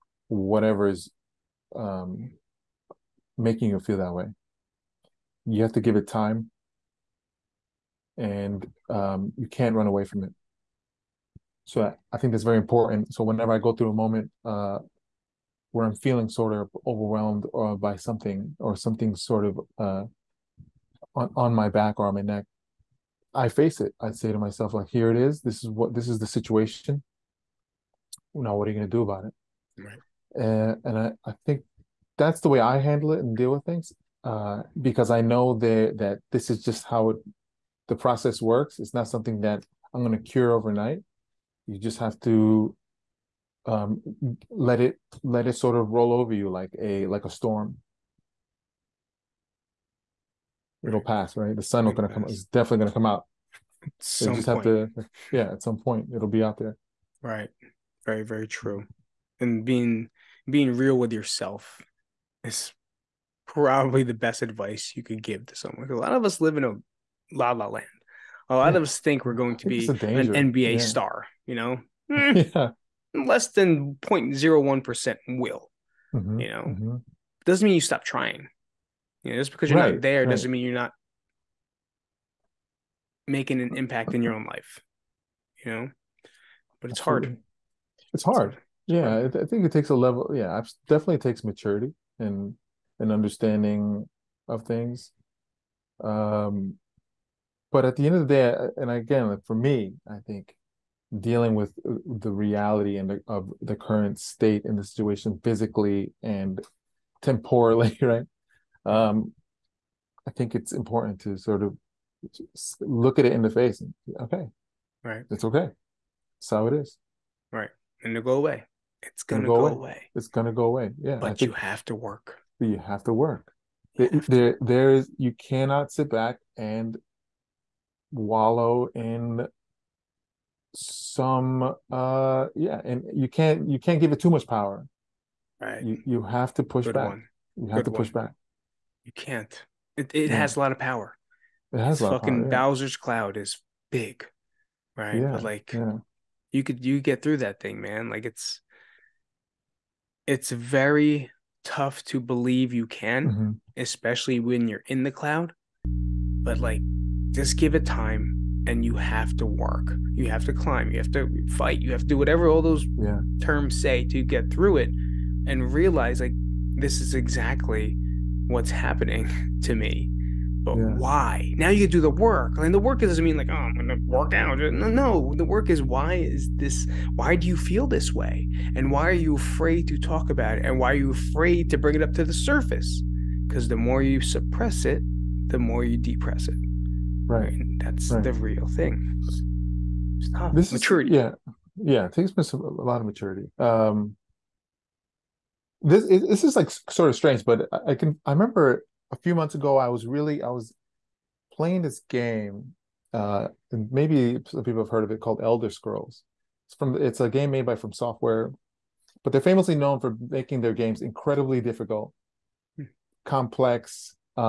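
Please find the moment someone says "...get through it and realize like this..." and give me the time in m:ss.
2:44.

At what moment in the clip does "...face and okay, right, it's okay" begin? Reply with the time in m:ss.
1:53.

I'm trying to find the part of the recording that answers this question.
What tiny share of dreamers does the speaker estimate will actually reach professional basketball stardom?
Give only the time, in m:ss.
1:14.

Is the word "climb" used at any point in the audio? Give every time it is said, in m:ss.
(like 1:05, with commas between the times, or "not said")
2:40.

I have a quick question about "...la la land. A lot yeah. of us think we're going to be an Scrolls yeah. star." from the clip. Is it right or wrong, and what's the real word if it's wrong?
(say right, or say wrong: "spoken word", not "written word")
wrong: "NBA", not "Scrolls".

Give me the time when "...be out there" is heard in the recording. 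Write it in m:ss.
0:56.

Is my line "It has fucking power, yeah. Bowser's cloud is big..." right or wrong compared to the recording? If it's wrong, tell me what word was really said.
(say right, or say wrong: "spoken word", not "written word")
right.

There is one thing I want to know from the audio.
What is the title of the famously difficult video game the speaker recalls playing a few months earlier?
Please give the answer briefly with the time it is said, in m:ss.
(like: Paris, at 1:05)
Elder Scrolls, at 3:25.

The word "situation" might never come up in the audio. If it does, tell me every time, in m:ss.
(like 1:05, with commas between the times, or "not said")
0:26, 1:44.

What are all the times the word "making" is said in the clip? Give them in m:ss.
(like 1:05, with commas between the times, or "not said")
0:03, 1:23, 3:30.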